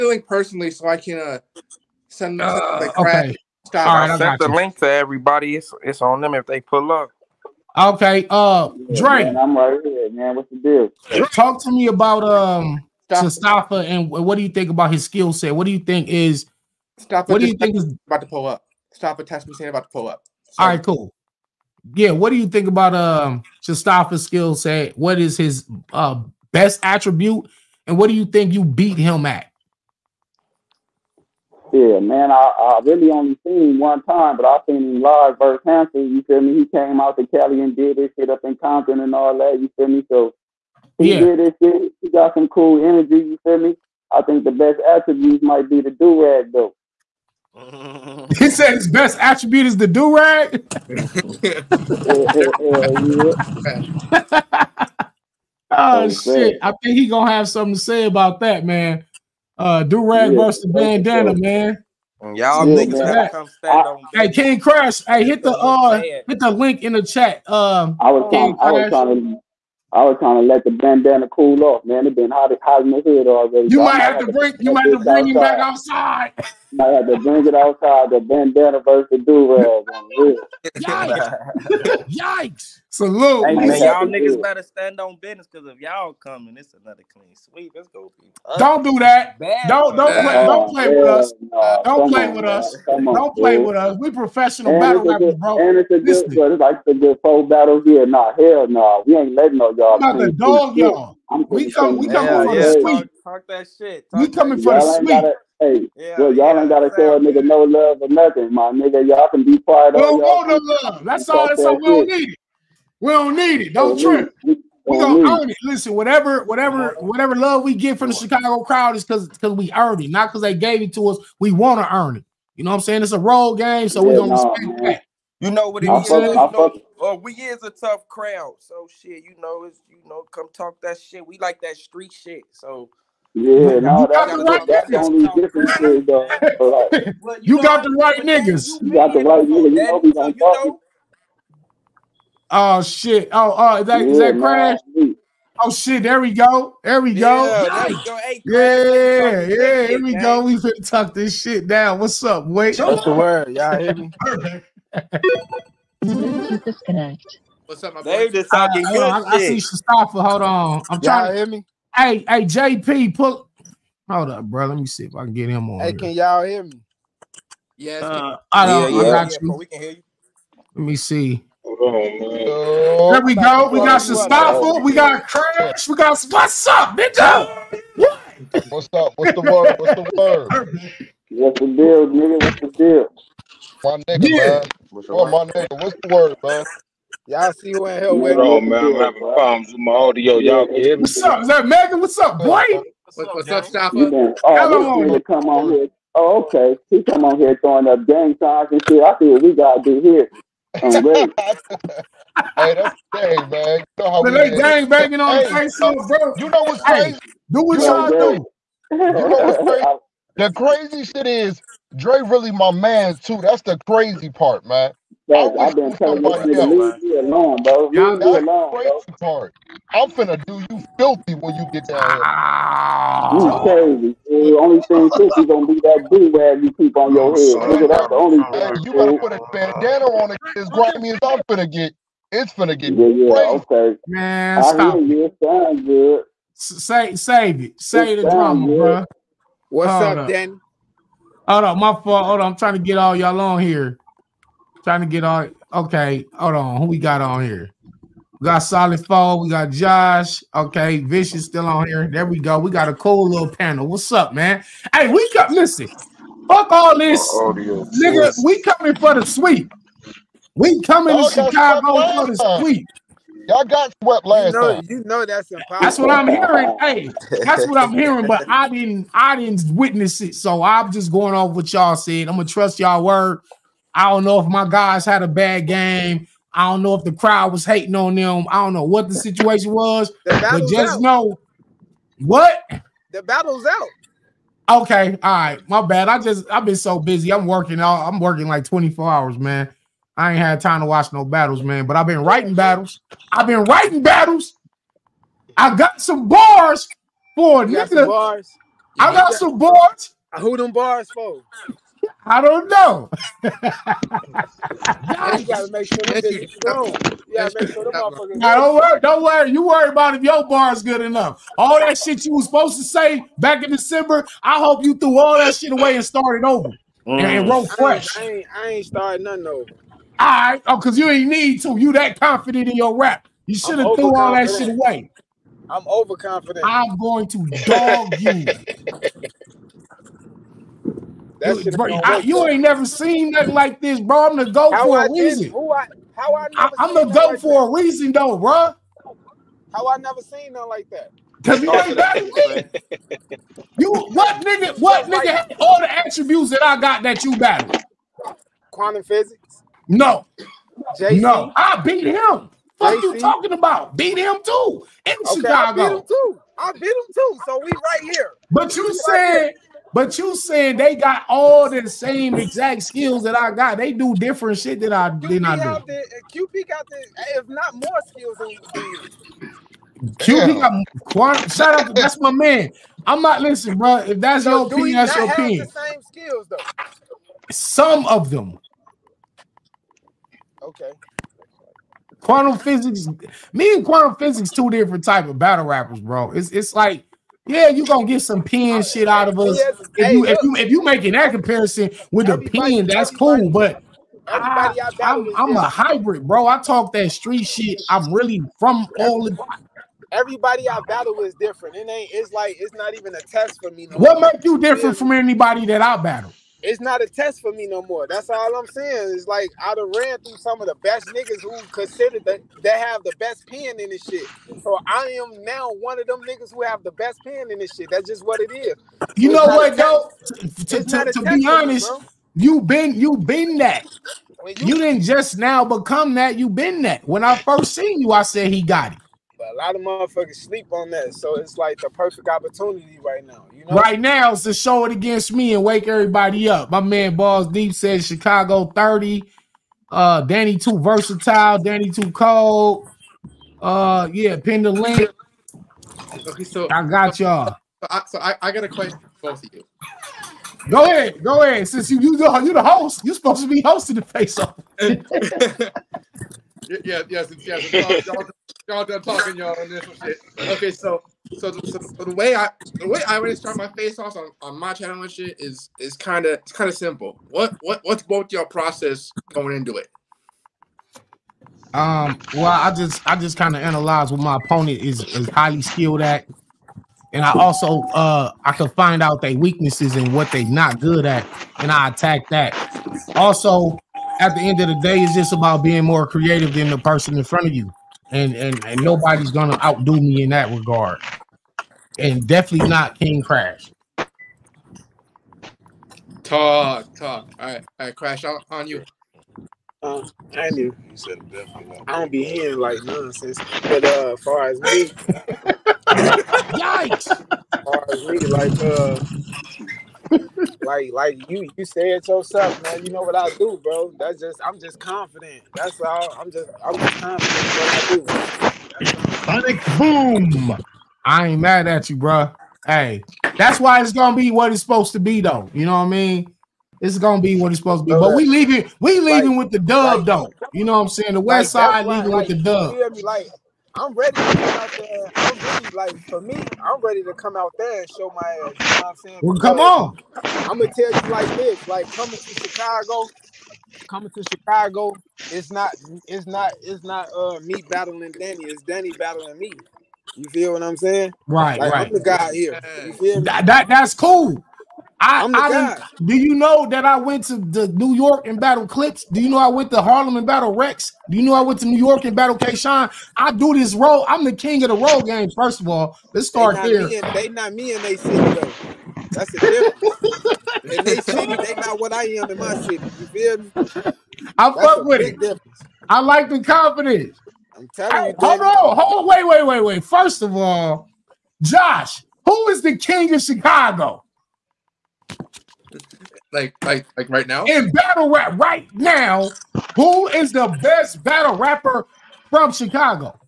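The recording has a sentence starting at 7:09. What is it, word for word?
But a lot of motherfuckers sleep on that.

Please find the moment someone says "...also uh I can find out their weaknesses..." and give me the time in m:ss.
7:57.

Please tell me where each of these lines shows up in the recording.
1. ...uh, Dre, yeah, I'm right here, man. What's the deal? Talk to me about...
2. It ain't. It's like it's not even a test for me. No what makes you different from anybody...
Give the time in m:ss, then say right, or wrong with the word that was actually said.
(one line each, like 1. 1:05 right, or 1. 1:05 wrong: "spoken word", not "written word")
1. 0:08 right
2. 6:41 right.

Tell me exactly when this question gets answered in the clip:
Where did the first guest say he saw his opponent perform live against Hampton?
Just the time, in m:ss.
0:38.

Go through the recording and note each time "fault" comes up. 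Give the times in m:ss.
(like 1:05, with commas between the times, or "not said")
4:02.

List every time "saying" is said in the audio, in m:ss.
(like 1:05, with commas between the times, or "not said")
0:19, 2:02, 6:00, 6:48, 8:50, 8:59, 9:10.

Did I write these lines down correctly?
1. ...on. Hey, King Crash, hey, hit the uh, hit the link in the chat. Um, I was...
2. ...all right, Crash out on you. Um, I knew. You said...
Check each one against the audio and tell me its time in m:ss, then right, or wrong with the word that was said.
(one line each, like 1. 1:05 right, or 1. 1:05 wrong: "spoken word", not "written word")
1. 1:03 right
2. 8:17 right.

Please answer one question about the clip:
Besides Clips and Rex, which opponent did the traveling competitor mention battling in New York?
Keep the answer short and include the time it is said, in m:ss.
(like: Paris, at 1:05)
K Shine, at 9:22.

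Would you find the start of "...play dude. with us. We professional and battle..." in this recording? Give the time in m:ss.
1:33.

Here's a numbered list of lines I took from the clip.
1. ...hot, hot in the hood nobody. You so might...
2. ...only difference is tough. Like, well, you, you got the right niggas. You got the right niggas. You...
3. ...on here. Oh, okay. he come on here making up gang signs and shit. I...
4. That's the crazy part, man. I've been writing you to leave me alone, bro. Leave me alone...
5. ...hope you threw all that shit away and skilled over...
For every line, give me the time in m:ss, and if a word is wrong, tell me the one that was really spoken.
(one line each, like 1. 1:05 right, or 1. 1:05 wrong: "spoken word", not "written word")
1. 1:12 wrong: "already", not "nobody"
2. 2:14 wrong: "though", not "tough"
3. 3:15 wrong: "throwing", not "making"
4. 3:33 wrong: "telling", not "writing"
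5. 5:14 wrong: "started", not "skilled".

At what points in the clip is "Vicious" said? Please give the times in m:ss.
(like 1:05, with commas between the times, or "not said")
4:10.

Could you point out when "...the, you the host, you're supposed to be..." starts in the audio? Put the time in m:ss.
7:32.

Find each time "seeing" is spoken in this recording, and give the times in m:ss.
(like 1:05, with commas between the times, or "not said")
not said.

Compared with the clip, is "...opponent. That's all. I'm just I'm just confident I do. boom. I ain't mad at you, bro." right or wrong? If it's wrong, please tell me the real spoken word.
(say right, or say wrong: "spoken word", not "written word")
wrong: "confident", not "opponent".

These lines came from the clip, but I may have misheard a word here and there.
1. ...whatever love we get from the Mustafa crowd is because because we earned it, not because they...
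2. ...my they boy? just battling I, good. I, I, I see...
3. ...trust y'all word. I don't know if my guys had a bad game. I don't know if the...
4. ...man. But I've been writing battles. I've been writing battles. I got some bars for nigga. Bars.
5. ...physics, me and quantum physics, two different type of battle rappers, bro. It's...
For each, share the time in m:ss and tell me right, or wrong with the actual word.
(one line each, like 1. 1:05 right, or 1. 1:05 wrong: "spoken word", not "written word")
1. 1:56 wrong: "Chicago", not "Mustafa"
2. 2:37 wrong: "talking", not "battling"
3. 4:32 right
4. 4:51 right
5. 6:22 right.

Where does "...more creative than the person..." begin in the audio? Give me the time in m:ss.
8:05.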